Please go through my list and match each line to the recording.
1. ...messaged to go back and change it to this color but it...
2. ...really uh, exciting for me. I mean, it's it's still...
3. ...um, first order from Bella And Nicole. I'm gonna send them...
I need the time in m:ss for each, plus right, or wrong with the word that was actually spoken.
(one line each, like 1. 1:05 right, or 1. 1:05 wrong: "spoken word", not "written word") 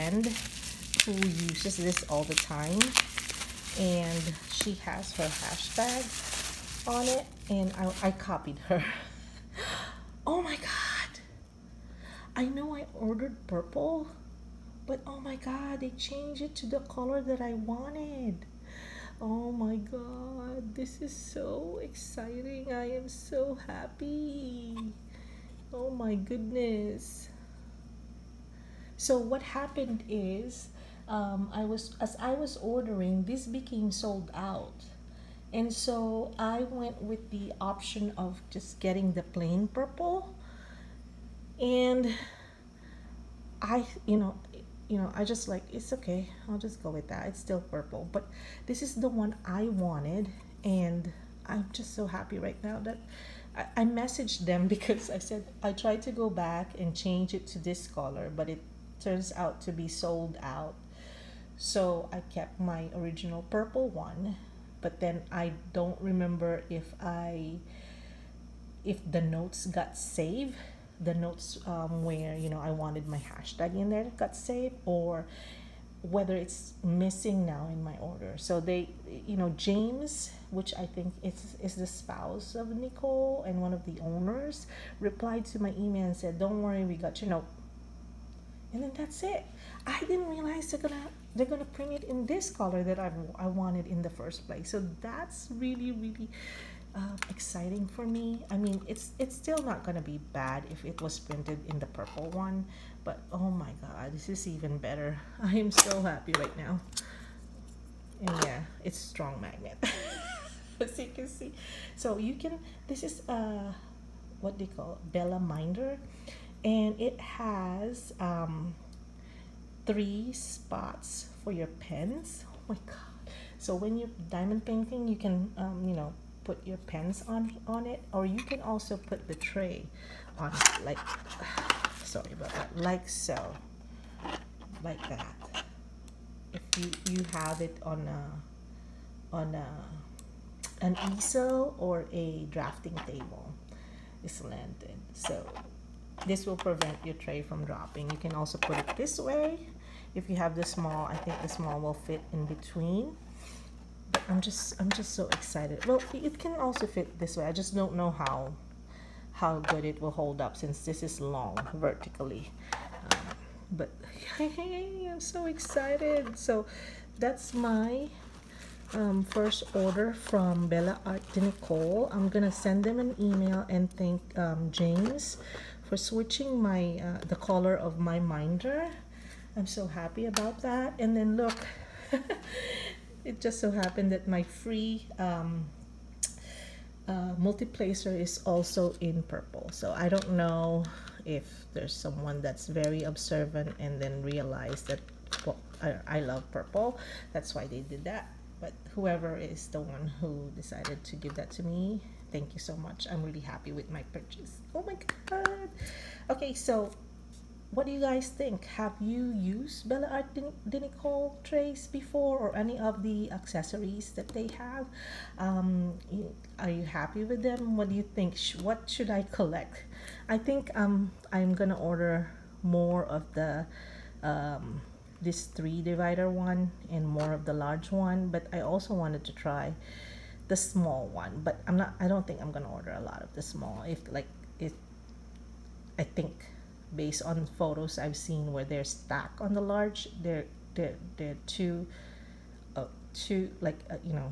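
1. 0:55 wrong: "tried", not "messaged"
2. 1:35 right
3. 2:48 wrong: "Art", not "And".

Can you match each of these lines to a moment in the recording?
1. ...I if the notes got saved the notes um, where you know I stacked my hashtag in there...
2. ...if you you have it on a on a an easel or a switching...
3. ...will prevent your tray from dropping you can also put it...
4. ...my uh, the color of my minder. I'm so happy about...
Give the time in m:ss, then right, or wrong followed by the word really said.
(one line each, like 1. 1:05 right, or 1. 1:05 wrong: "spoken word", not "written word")
1. 1:07 wrong: "wanted", not "stacked"
2. 2:16 wrong: "drafting", not "switching"
3. 2:26 right
4. 2:56 right.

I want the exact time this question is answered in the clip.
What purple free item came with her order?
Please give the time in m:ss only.
3:07.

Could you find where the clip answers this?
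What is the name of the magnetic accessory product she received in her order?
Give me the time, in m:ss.
1:55.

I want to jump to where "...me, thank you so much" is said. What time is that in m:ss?
3:21.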